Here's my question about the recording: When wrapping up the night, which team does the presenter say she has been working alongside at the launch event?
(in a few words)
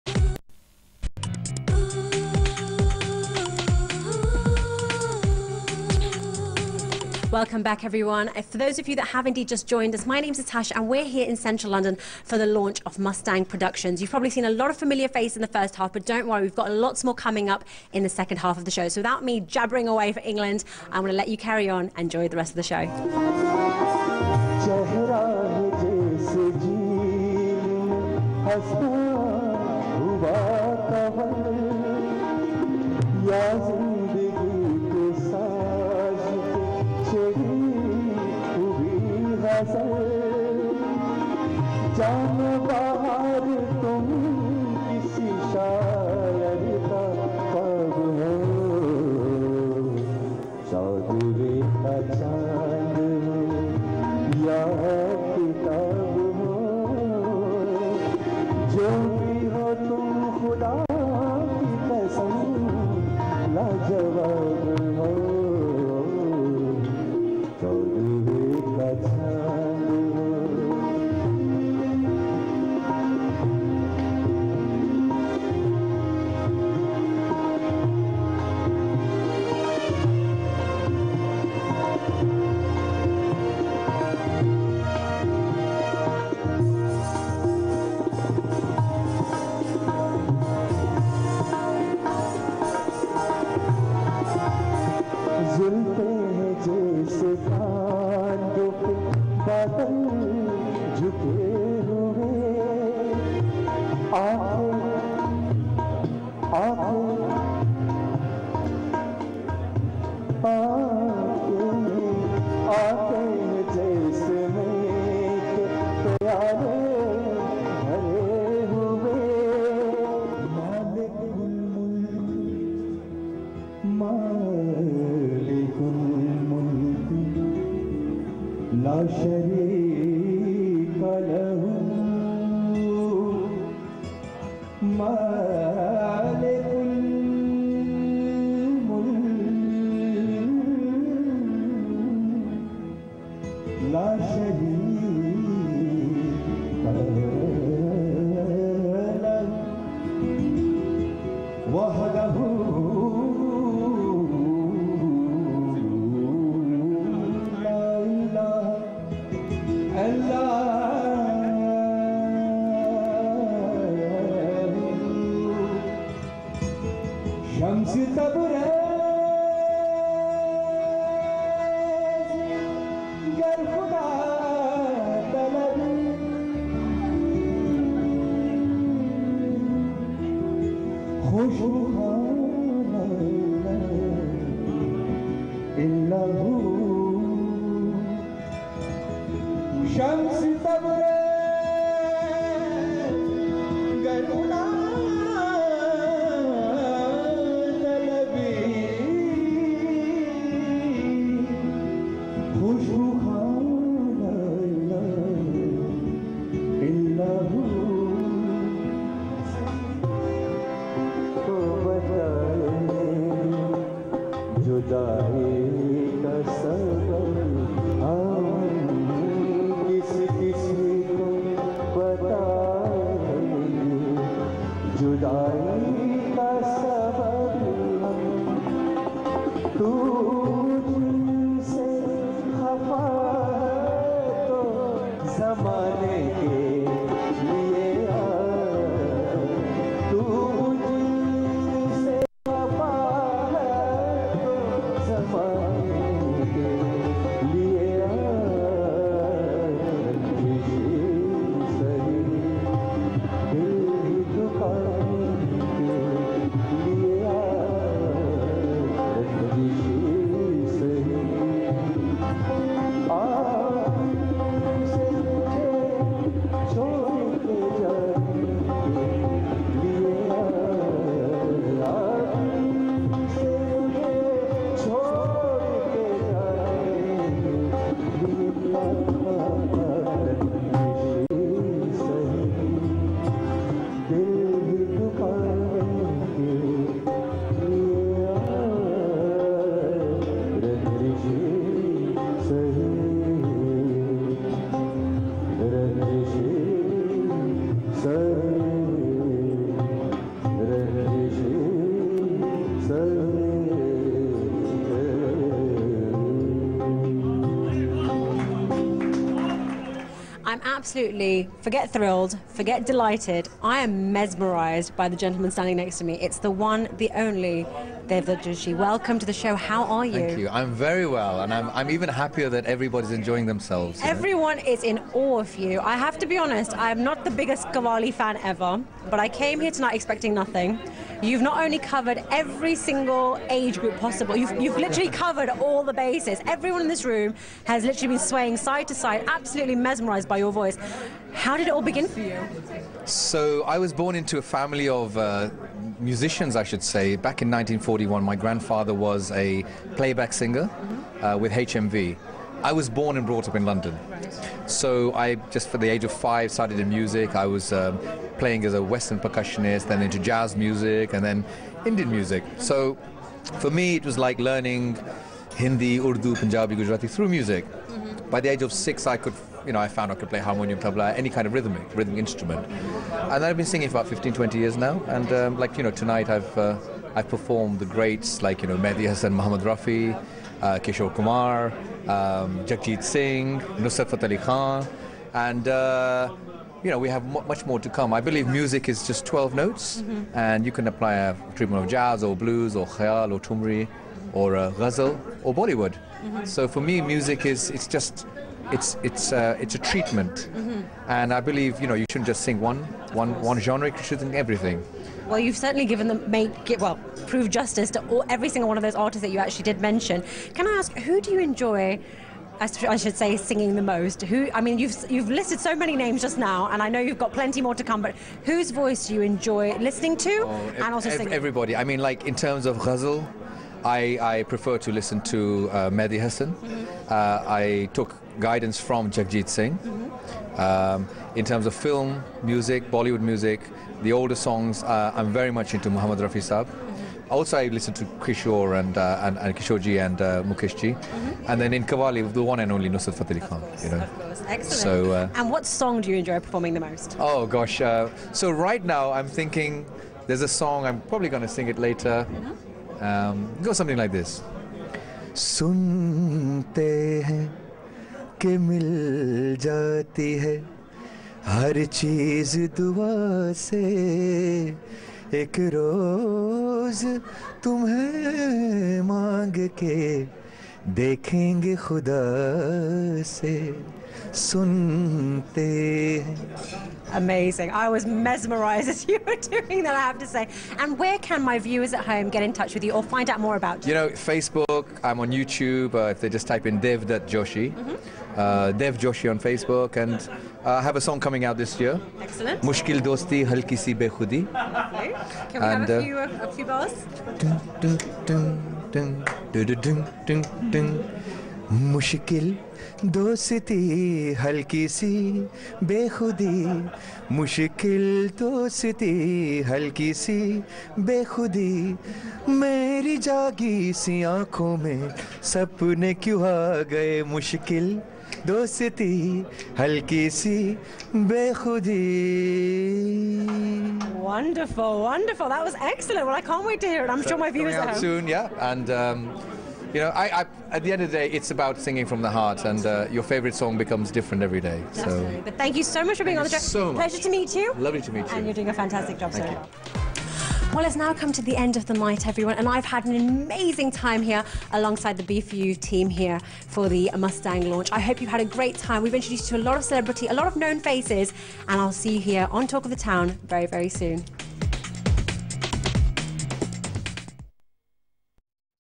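B4U.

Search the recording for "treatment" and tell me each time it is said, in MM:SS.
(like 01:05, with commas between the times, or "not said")
06:31, 06:39.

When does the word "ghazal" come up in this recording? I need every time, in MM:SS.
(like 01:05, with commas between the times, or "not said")
06:34, 07:02.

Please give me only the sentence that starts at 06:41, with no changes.
and I believe you know you shouldn't just sing one one one genre.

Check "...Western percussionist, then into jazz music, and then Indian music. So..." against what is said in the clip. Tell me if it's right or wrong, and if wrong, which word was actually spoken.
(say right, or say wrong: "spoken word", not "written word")
right.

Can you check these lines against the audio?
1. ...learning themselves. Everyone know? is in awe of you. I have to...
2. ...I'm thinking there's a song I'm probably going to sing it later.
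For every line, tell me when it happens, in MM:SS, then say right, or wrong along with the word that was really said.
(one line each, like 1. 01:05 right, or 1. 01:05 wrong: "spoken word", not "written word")
1. 05:23 wrong: "enjoying", not "learning"
2. 07:29 right.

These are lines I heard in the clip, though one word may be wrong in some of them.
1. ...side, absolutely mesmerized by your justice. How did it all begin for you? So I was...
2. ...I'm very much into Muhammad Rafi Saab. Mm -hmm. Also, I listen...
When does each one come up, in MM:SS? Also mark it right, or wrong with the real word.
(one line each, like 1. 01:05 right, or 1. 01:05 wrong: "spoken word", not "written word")
1. 05:38 wrong: "voice", not "justice"
2. 07:15 right.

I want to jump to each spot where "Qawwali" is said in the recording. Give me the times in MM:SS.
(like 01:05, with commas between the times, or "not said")
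05:27, 07:21.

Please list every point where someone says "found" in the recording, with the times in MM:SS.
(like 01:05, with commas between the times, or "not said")
06:09.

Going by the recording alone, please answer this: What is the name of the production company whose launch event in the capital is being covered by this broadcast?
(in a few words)
Mustang Productions.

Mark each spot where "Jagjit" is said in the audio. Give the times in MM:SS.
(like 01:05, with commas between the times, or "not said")
06:22, 07:09.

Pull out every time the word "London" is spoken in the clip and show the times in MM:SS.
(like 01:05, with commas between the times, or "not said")
00:11, 05:53.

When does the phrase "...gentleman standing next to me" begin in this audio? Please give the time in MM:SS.
05:15.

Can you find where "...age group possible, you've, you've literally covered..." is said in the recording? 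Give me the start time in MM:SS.
05:33.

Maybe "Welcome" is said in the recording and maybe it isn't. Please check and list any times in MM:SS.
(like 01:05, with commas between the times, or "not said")
00:07, 05:18.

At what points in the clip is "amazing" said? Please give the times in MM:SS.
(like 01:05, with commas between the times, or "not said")
07:57, 09:03.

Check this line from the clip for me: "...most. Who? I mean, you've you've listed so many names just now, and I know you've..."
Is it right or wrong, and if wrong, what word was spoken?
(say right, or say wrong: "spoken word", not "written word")
right.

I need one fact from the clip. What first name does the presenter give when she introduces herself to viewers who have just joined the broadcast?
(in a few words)
Natasha.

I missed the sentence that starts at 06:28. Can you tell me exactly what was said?
I believe music is just 12 notes, mm -hmm.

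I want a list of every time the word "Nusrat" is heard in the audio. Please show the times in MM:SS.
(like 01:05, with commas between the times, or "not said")
06:23, 07:22.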